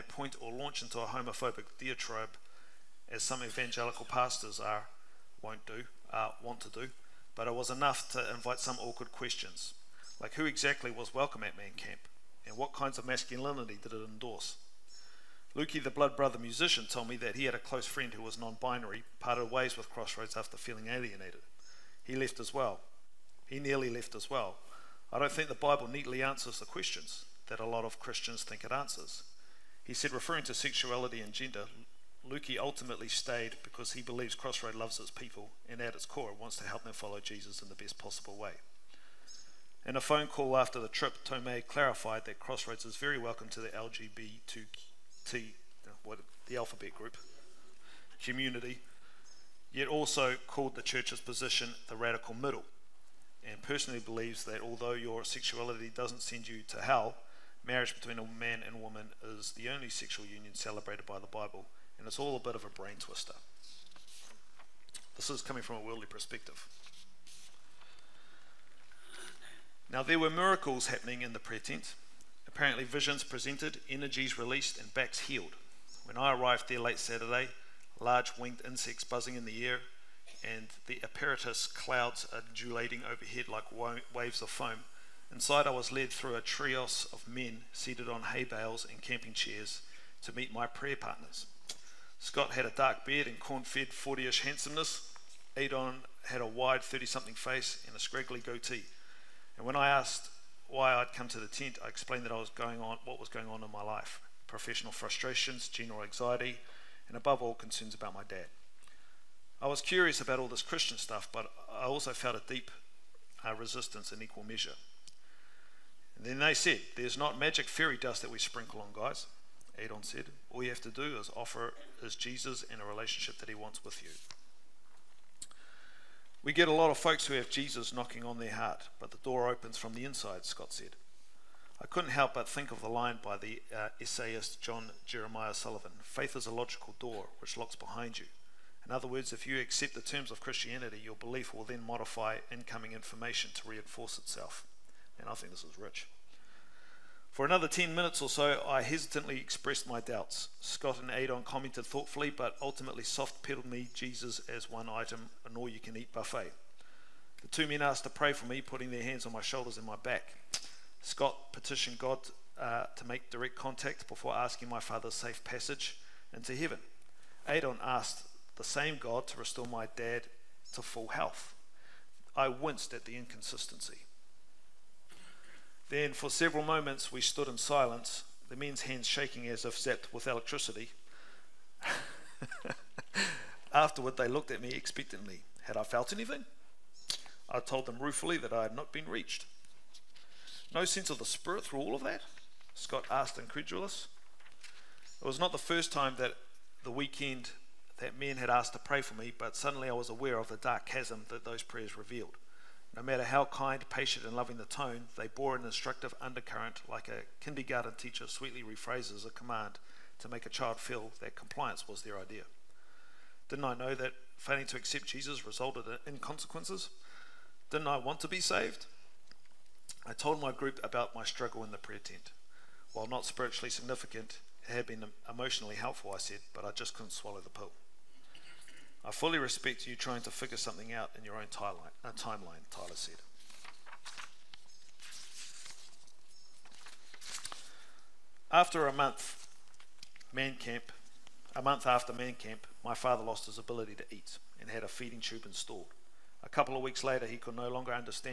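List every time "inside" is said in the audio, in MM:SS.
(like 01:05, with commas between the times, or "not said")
01:25, 02:10.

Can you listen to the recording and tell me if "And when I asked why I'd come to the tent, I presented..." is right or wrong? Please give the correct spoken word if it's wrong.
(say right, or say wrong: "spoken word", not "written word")
wrong: "explained", not "presented".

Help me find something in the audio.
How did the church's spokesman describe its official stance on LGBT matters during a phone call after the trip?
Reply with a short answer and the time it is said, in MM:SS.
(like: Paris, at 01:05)
the radical middle, at 00:51.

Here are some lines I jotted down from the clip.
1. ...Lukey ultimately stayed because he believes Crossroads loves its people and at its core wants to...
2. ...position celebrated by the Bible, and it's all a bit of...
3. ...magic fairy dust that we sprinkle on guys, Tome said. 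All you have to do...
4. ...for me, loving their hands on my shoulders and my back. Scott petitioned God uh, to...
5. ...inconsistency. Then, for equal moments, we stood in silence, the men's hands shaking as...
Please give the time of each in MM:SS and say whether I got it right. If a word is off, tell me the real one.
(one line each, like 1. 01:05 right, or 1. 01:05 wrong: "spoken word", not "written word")
1. 00:32 right
2. 01:00 wrong: "union", not "position"
3. 01:57 wrong: "Adon", not "Tome"
4. 02:38 wrong: "putting", not "loving"
5. 02:53 wrong: "several", not "equal".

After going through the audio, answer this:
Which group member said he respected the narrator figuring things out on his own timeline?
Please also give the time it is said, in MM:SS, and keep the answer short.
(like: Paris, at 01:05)
Tyler, at 03:52.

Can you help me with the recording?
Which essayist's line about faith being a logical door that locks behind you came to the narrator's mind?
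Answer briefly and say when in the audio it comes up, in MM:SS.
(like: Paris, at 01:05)
John Jeremiah Sullivan, at 02:14.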